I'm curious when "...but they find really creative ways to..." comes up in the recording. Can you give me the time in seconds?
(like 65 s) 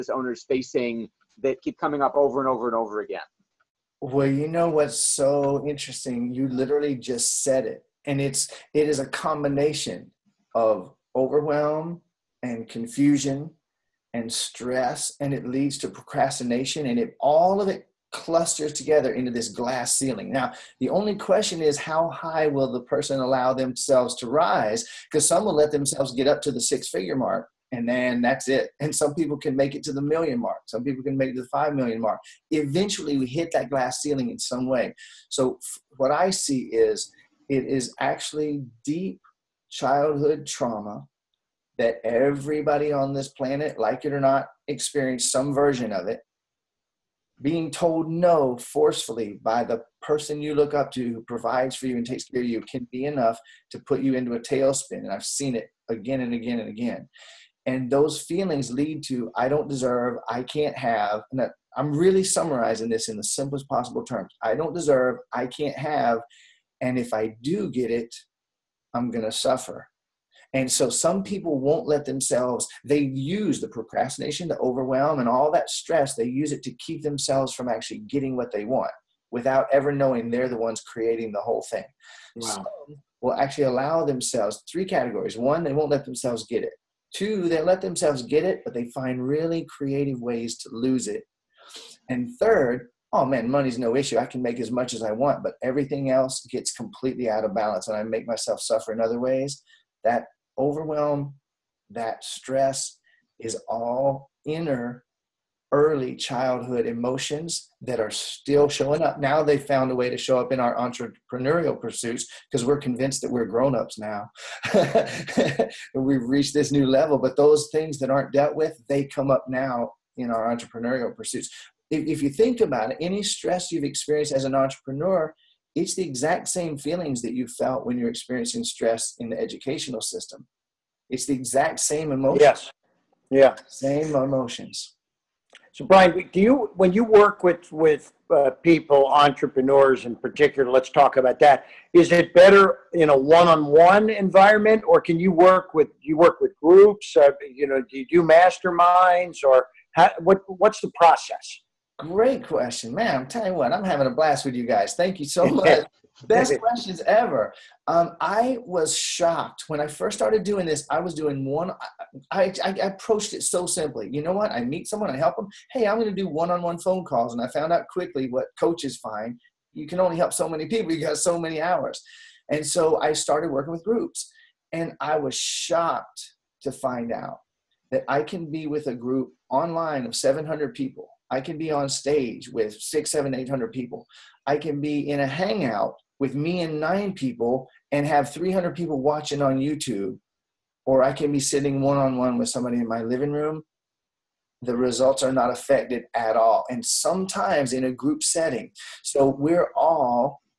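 88 s.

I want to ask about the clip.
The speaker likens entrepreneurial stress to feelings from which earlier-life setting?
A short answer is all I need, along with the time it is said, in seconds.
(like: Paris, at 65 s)
the educational system, at 129 s.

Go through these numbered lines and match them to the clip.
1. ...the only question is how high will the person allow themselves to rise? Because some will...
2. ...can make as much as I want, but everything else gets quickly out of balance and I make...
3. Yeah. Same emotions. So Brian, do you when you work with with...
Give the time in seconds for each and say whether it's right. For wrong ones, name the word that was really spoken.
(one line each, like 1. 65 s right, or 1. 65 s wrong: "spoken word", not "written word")
1. 20 s right
2. 94 s wrong: "completely", not "quickly"
3. 133 s right.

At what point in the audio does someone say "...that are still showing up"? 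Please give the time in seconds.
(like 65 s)
107 s.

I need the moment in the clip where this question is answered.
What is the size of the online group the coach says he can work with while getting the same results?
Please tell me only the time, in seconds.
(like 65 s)
180 s.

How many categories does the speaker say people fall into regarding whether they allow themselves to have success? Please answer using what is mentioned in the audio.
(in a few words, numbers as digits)
3.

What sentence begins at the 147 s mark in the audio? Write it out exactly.
Uh, you know, do you do masterminds, or how, what?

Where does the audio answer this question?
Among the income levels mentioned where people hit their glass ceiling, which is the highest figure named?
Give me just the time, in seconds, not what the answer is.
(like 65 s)
31 s.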